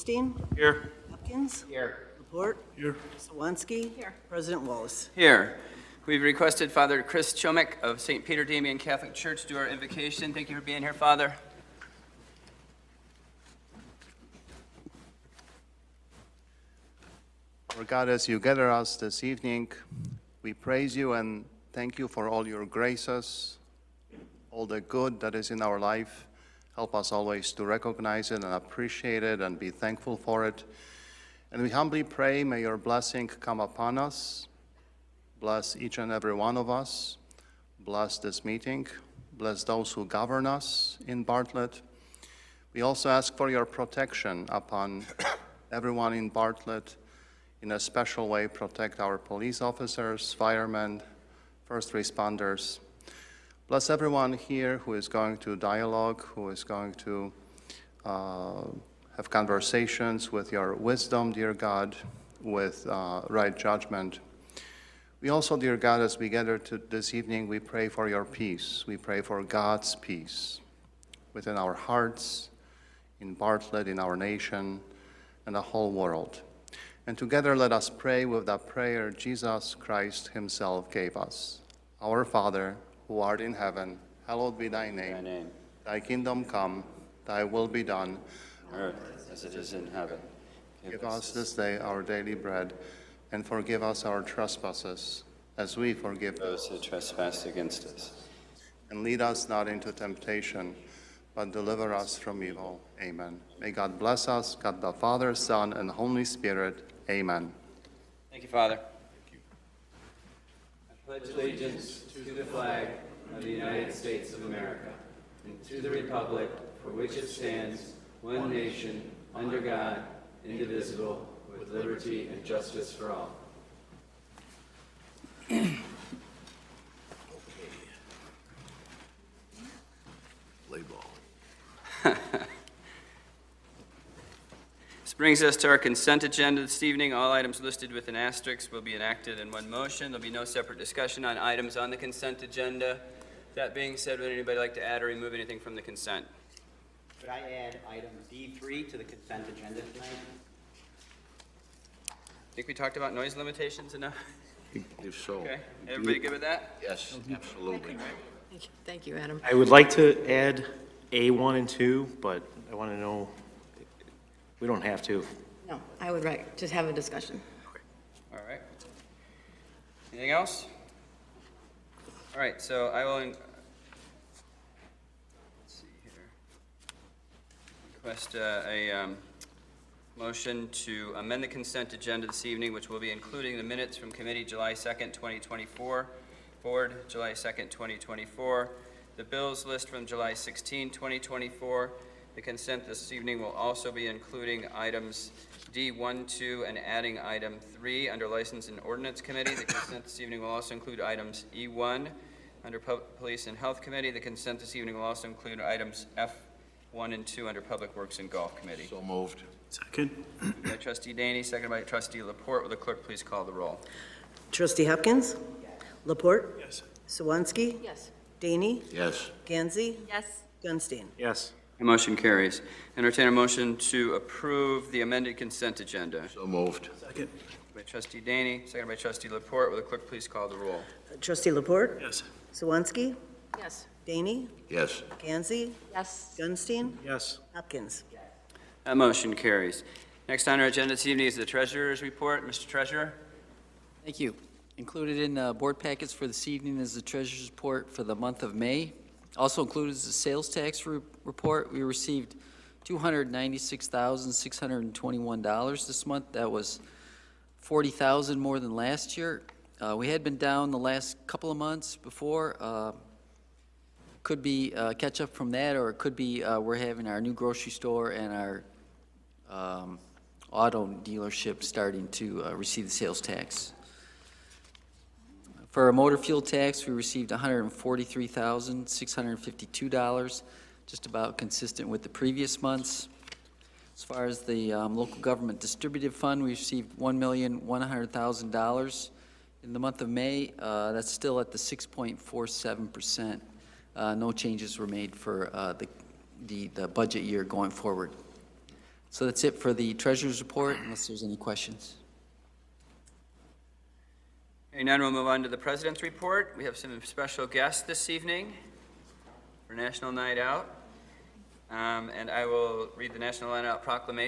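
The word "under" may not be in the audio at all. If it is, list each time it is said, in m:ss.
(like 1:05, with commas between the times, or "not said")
1:59, 3:18, 3:22, 3:27.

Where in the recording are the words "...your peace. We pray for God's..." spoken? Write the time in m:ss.
1:08.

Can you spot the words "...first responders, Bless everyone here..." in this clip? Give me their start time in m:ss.
0:51.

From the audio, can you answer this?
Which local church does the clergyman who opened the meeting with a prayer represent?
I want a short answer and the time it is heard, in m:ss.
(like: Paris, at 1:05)
St. Peter Damian Catholic Church, at 0:08.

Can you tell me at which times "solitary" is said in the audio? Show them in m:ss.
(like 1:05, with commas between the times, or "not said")
not said.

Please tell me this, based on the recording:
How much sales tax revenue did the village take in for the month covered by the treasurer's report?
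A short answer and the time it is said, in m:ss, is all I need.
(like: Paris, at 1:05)
$296,621, at 4:12.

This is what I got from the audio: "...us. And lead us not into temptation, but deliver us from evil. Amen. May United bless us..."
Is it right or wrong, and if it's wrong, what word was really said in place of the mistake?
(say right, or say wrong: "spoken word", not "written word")
wrong: "God", not "United".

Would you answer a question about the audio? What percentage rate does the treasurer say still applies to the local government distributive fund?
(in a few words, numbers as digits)
6.47%.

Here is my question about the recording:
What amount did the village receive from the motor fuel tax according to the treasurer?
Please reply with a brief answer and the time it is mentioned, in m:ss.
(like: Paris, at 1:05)
$143,652, at 4:37.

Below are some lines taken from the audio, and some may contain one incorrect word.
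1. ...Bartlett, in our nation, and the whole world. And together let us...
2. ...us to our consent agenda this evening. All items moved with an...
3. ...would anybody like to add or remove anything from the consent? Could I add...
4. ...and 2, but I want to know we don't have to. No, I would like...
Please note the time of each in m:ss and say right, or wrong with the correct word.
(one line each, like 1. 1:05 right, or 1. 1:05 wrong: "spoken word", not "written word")
1. 1:13 right
2. 2:15 wrong: "listed", not "moved"
3. 2:24 right
4. 2:41 right.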